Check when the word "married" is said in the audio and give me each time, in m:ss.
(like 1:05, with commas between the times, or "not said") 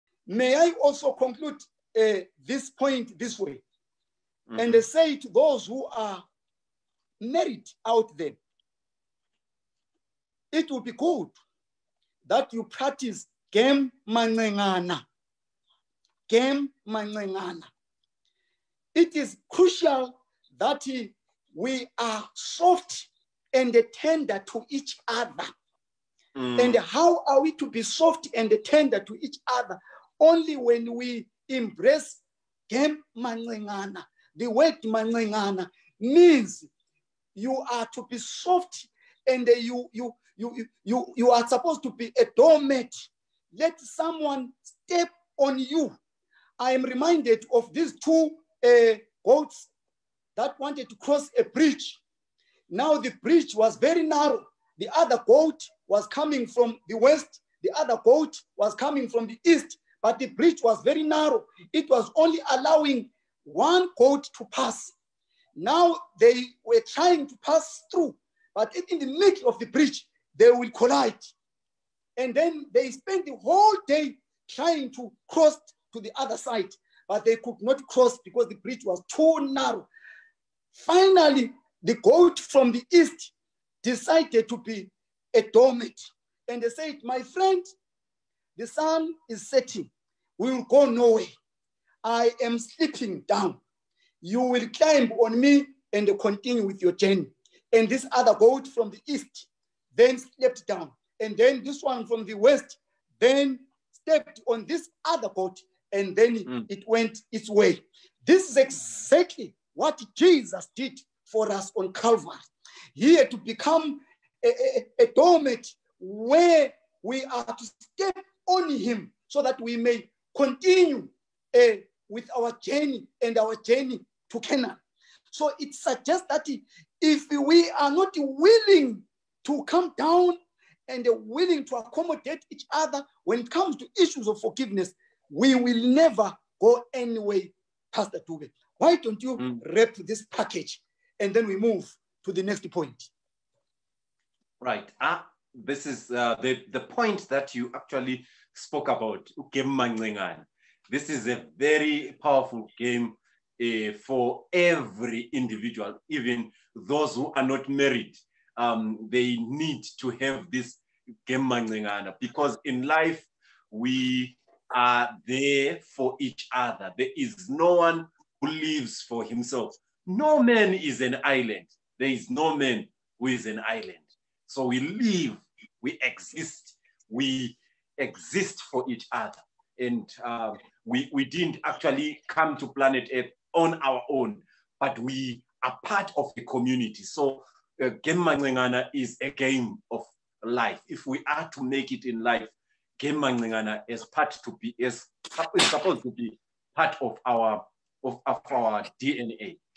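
0:07, 2:37.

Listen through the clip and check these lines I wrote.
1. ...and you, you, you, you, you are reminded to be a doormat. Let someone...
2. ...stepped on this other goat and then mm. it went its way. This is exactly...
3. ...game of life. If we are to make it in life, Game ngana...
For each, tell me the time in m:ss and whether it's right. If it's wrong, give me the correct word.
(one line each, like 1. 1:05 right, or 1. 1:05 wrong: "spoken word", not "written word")
1. 0:39 wrong: "supposed", not "reminded"
2. 1:43 right
3. 3:09 right.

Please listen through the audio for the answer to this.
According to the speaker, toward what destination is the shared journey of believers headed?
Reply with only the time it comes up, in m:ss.
2:04.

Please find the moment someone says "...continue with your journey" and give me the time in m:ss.
1:36.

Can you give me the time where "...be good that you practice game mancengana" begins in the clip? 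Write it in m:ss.
0:10.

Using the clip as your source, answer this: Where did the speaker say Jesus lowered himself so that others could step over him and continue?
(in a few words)
Calvary.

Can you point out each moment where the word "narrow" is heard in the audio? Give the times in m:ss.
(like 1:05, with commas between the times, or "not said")
0:54, 1:01, 1:19.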